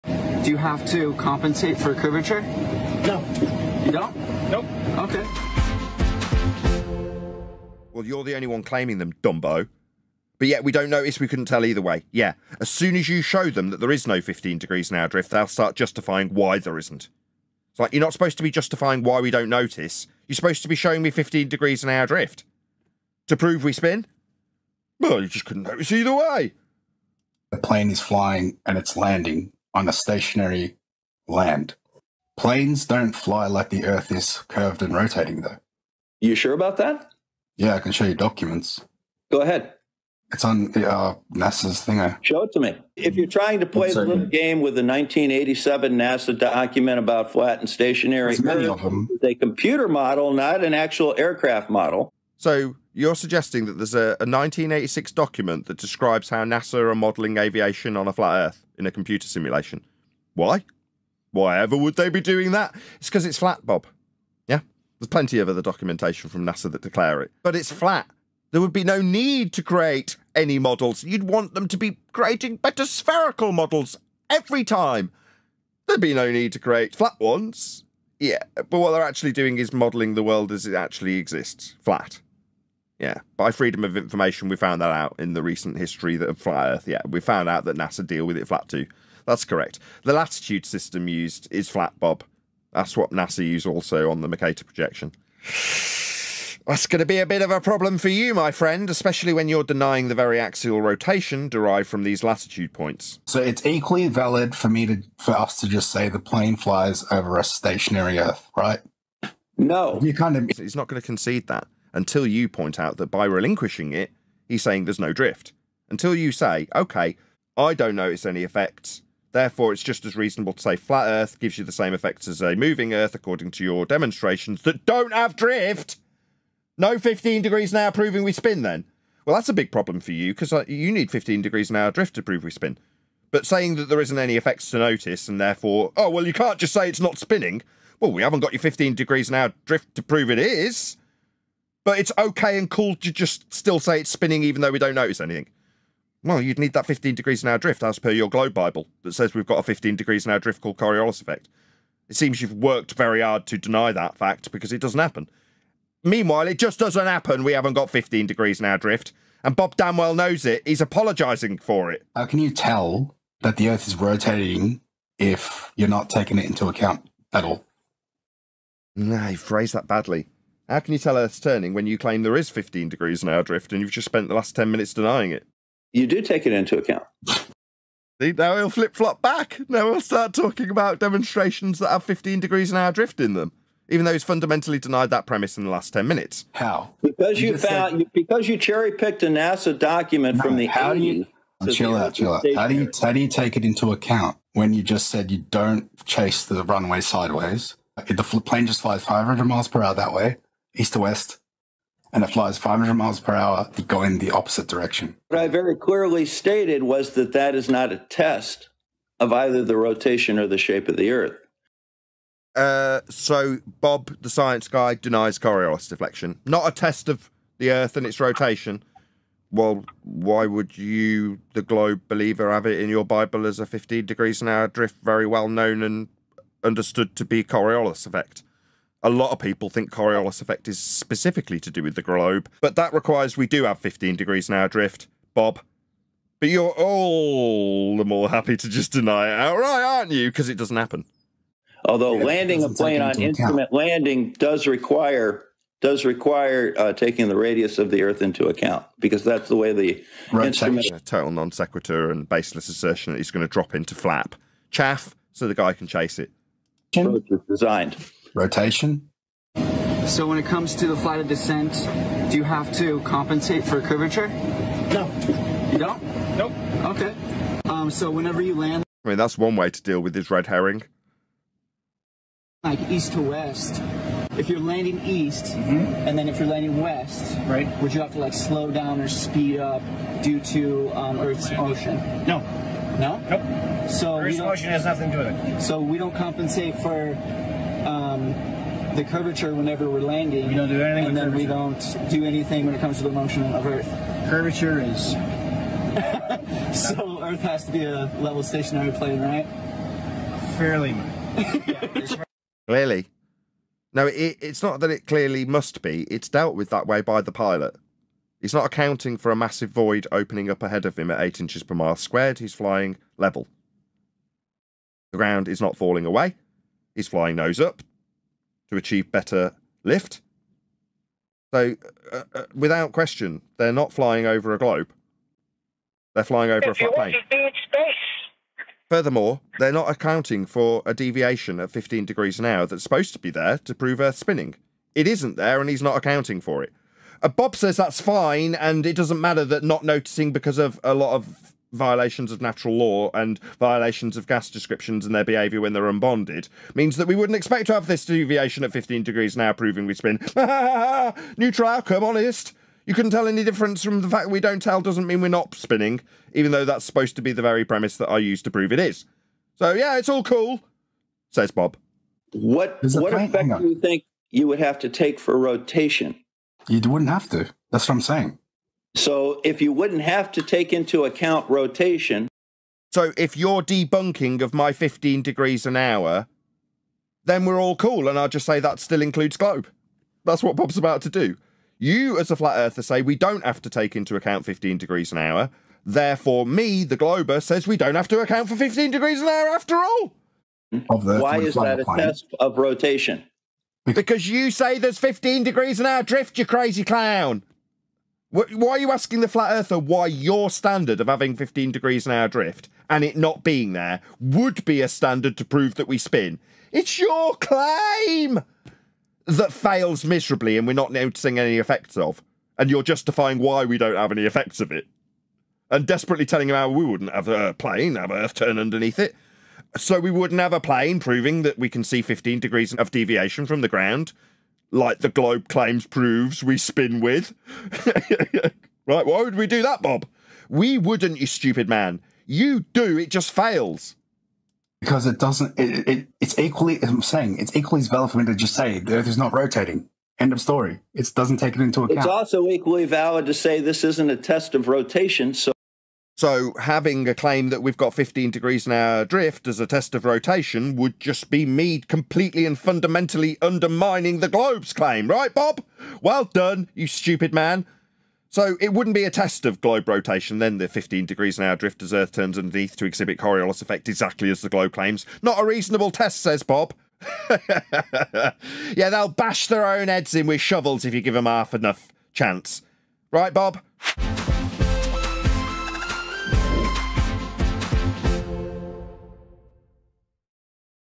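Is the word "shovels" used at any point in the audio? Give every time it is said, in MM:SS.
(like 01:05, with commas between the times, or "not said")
07:50.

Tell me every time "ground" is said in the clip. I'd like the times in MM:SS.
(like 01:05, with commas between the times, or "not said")
05:15, 07:03.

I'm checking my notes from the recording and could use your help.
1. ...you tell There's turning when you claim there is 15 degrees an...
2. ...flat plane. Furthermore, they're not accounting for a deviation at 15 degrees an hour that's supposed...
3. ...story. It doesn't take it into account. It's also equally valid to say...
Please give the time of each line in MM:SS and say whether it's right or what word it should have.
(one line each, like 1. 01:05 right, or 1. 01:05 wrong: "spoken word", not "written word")
1. 02:50 wrong: "Earth", not "There"
2. 05:26 right
3. 07:20 right.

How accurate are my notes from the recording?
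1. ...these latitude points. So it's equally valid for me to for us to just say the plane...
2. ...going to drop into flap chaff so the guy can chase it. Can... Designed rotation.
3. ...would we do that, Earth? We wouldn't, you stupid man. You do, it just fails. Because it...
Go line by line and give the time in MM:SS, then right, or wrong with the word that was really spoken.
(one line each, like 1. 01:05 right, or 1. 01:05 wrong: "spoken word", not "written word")
1. 01:42 right
2. 04:13 right
3. 07:09 wrong: "Bob", not "Earth".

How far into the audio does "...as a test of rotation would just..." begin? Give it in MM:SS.
07:29.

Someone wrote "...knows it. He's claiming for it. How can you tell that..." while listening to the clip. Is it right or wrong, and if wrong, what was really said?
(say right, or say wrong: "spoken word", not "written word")
wrong: "apologising", not "claiming".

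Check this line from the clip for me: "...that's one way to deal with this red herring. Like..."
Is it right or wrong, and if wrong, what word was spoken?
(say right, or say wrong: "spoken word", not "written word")
right.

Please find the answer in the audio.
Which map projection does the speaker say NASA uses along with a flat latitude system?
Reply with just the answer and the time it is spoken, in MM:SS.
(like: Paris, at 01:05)
Mercator projection, at 01:34.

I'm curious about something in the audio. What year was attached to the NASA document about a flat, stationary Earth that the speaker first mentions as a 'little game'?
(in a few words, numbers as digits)
1987.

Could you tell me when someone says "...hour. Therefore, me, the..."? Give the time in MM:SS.
06:25.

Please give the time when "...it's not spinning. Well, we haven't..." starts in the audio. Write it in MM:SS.
02:16.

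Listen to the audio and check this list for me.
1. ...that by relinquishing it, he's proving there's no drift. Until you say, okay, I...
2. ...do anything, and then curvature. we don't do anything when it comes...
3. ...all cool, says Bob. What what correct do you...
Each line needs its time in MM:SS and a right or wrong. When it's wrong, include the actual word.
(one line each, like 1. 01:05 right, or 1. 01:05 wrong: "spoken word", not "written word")
1. 01:52 wrong: "saying", not "proving"
2. 04:50 right
3. 06:00 wrong: "effect", not "correct".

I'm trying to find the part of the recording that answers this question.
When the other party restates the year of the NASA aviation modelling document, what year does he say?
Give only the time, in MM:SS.
00:54.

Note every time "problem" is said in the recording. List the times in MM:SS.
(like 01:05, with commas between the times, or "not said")
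01:37, 02:09.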